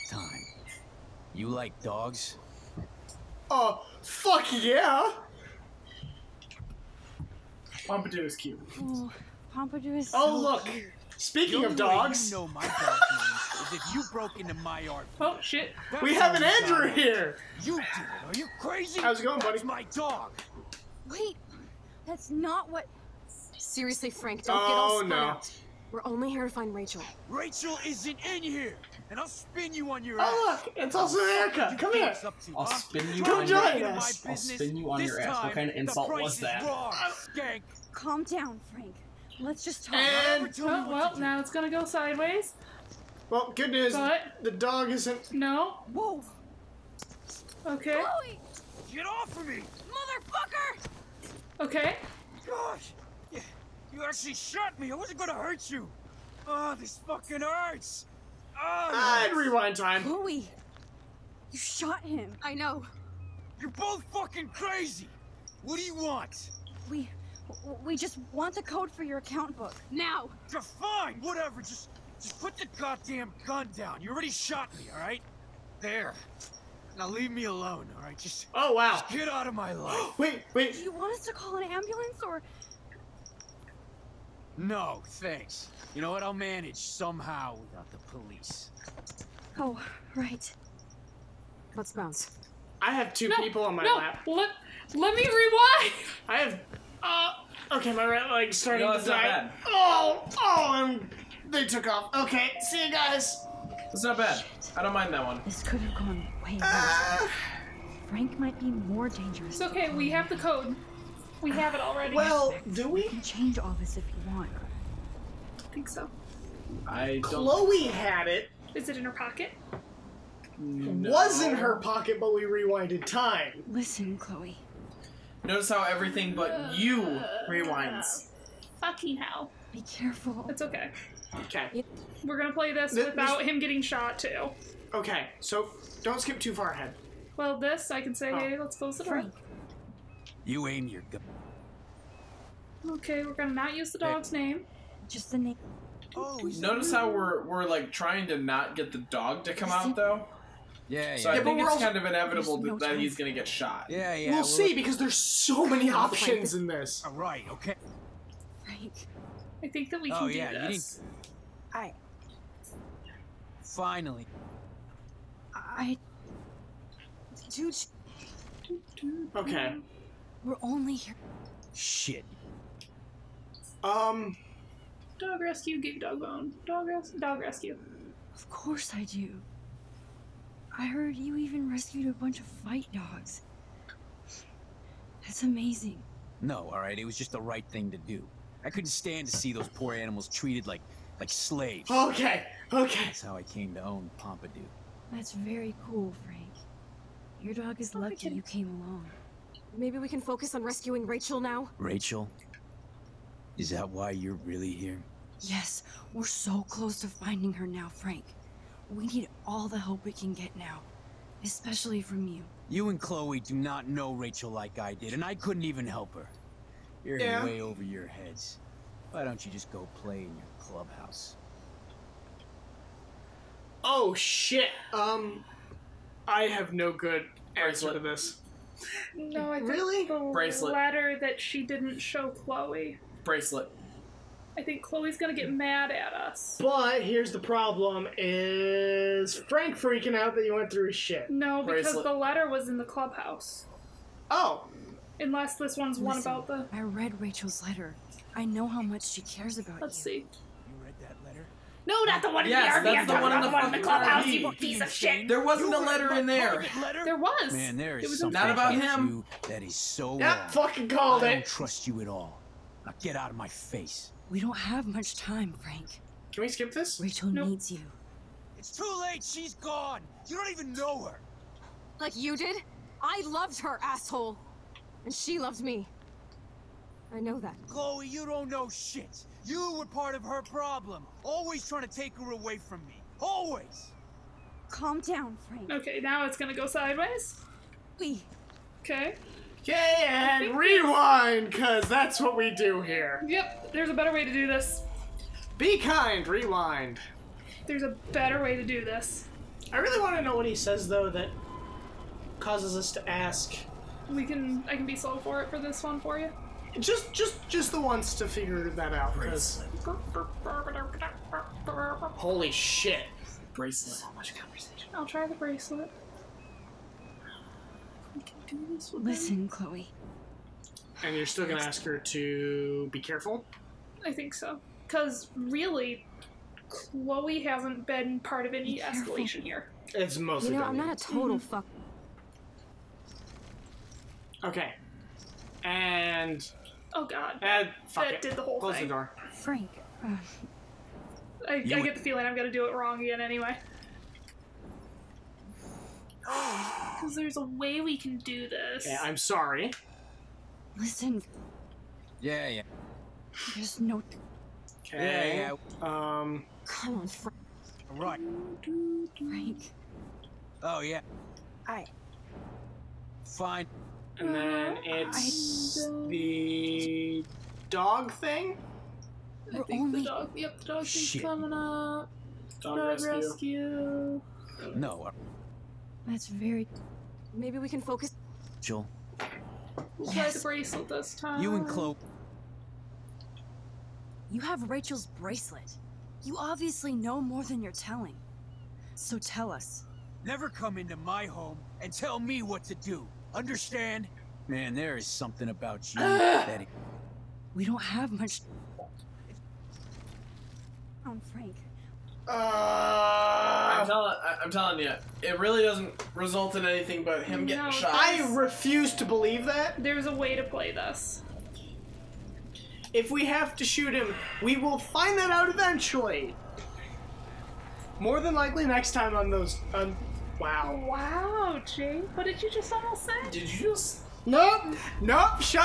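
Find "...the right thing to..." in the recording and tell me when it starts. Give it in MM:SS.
03:07.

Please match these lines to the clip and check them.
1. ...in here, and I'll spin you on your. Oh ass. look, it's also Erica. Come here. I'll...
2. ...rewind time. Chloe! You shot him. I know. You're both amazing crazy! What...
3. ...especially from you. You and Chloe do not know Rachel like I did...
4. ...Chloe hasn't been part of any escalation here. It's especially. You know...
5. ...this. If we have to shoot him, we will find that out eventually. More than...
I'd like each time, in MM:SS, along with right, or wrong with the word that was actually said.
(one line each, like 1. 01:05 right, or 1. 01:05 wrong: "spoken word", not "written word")
1. 00:28 right
2. 00:59 wrong: "fucking", not "amazing"
3. 03:31 right
4. 05:26 wrong: "mostly", not "especially"
5. 06:50 right.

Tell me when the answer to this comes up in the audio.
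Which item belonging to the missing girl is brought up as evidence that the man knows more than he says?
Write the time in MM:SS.
06:24.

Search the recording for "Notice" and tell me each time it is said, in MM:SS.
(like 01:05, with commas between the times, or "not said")
02:05, 02:26.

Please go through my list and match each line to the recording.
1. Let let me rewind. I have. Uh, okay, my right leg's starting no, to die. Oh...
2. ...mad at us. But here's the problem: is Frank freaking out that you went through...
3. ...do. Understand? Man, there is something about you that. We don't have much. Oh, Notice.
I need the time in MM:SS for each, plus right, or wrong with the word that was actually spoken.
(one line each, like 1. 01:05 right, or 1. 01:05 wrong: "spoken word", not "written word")
1. 01:34 right
2. 03:55 right
3. 06:32 wrong: "Frank", not "Notice".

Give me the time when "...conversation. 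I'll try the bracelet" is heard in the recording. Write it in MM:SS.
05:14.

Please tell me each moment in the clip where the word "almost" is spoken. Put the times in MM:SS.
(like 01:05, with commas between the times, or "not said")
07:02.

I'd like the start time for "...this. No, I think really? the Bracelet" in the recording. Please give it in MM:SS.
03:47.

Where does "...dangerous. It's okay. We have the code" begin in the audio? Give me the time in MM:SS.
01:49.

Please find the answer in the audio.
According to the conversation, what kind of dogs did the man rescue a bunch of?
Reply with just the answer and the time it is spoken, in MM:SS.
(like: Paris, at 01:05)
Fight dogs, at 03:02.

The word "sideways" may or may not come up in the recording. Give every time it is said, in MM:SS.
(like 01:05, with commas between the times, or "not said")
00:41, 04:46.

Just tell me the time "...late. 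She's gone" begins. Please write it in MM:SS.
04:29.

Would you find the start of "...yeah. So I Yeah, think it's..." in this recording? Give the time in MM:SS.
02:31.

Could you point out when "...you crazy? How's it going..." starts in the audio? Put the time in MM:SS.
00:18.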